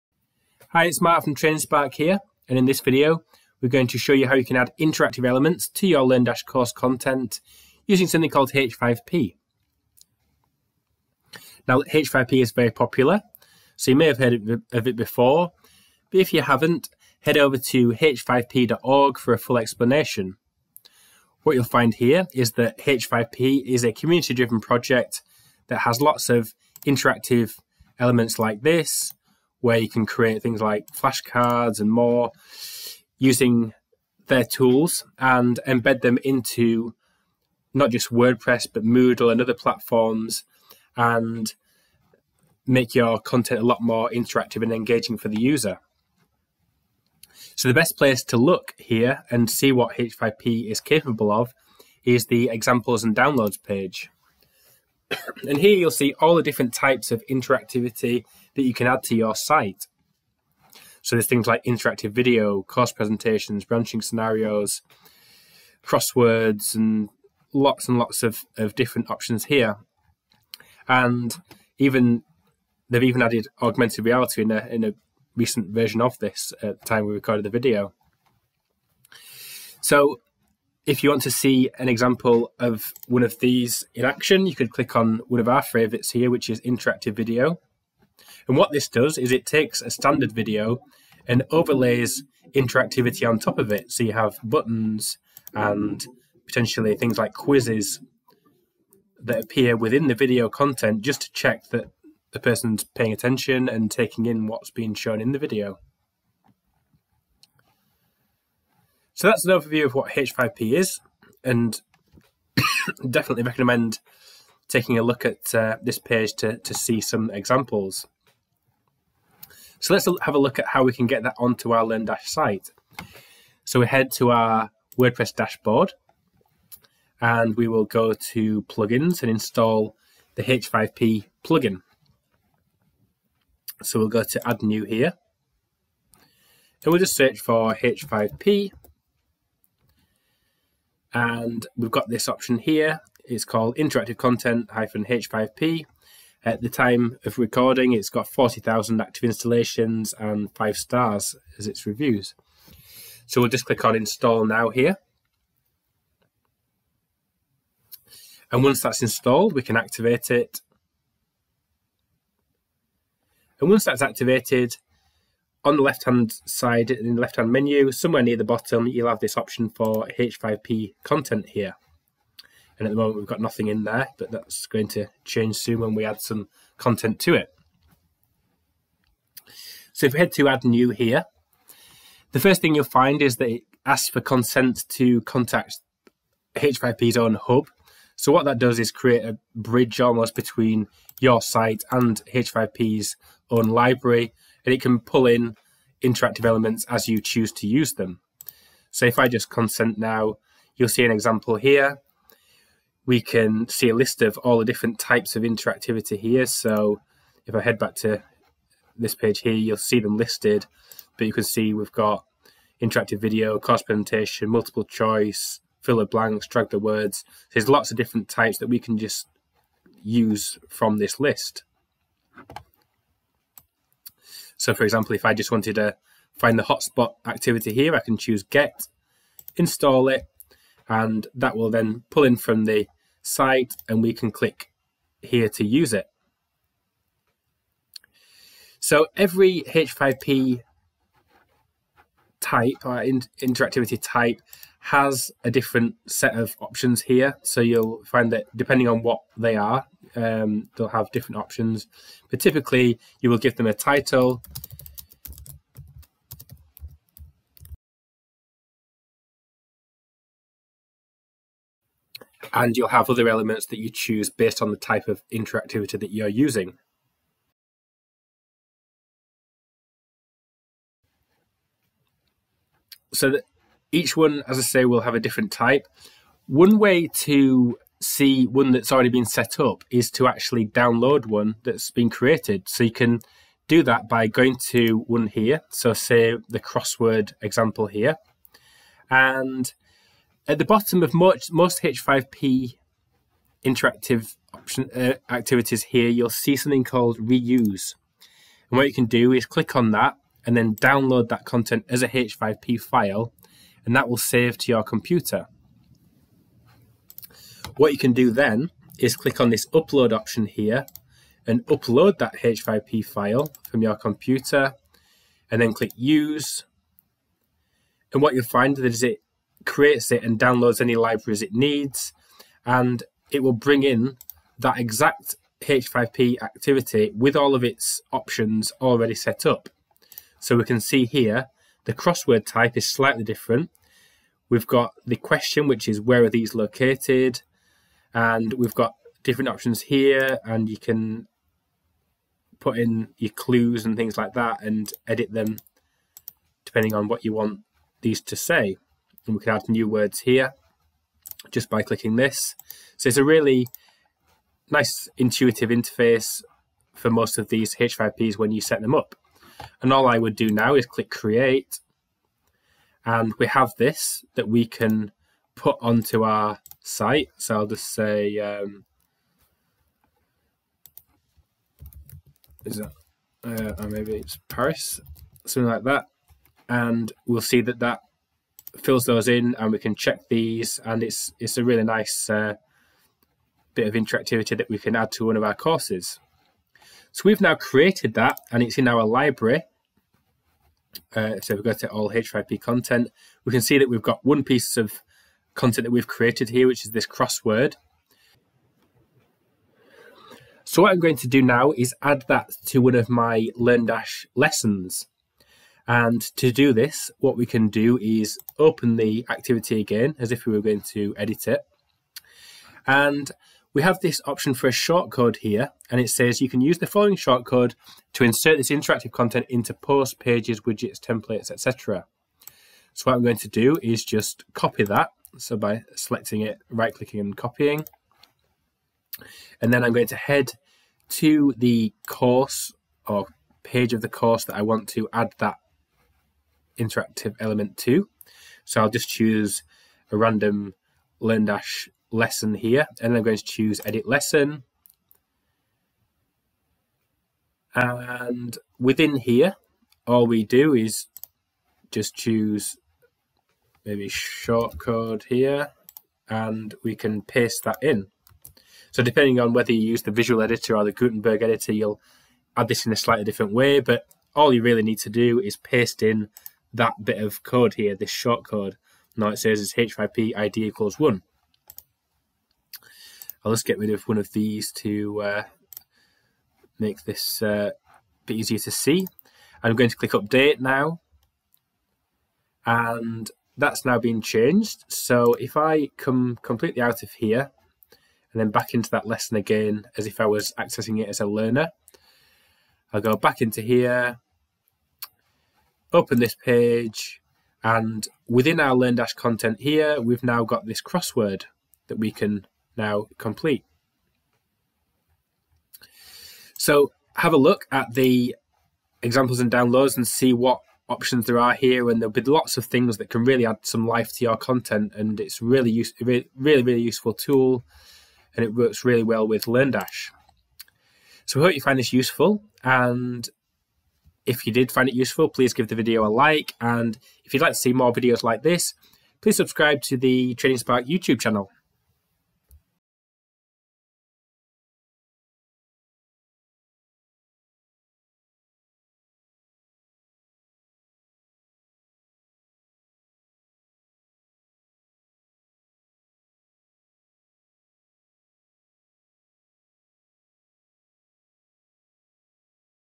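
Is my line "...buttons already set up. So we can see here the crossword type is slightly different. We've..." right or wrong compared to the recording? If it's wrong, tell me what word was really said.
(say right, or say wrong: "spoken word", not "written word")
wrong: "options", not "buttons".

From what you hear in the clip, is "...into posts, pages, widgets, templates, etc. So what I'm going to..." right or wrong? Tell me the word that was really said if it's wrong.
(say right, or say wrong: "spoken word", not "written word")
right.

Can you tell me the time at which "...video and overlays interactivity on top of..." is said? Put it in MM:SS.
01:30.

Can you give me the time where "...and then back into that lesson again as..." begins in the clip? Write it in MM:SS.
08:08.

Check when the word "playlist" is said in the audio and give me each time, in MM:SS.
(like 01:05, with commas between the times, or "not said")
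not said.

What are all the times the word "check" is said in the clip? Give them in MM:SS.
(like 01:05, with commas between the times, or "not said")
01:41, 06:19.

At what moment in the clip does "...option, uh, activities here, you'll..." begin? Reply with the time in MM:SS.
04:54.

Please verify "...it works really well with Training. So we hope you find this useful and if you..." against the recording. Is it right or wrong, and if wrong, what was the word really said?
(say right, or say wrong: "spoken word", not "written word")
wrong: "LearnDash", not "Training".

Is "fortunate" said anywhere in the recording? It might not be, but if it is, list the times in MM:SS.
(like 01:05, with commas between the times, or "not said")
not said.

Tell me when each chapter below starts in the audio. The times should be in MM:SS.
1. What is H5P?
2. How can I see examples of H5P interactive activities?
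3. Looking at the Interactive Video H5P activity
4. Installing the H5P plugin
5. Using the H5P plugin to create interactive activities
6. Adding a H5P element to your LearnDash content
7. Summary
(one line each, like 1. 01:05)
1. 00:15
2. 00:49
3. 01:20
4. 02:00
5. 02:43
6. 06:40
7. 08:25.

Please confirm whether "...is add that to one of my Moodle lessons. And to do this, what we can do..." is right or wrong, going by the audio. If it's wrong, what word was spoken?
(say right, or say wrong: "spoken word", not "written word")
wrong: "LearnDash", not "Moodle".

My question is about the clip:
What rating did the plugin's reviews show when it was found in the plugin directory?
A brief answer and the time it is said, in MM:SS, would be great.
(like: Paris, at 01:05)
five stars, at 02:30.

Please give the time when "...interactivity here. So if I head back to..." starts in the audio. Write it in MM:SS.
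03:25.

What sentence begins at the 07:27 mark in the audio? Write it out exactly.
And within here, all we do is just choose maybe short code here, and we can paste that in.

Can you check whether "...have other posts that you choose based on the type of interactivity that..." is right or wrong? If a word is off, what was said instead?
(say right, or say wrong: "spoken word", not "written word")
wrong: "elements", not "posts".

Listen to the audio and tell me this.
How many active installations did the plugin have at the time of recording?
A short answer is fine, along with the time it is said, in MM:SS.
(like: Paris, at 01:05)
40,000, at 02:28.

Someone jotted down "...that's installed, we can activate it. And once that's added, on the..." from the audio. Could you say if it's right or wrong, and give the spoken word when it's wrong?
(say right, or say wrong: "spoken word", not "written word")
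wrong: "activated", not "added".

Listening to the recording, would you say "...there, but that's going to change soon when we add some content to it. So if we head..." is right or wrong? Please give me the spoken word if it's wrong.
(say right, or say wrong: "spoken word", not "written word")
right.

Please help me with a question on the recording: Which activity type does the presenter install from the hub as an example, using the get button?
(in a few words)
hotspot.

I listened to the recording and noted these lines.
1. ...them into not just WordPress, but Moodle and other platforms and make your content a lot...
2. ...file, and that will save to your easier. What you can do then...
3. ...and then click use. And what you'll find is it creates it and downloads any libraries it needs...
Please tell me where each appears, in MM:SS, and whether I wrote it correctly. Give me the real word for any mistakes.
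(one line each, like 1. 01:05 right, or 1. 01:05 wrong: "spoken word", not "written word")
1. 00:36 right
2. 05:02 wrong: "computer", not "easier"
3. 05:15 right.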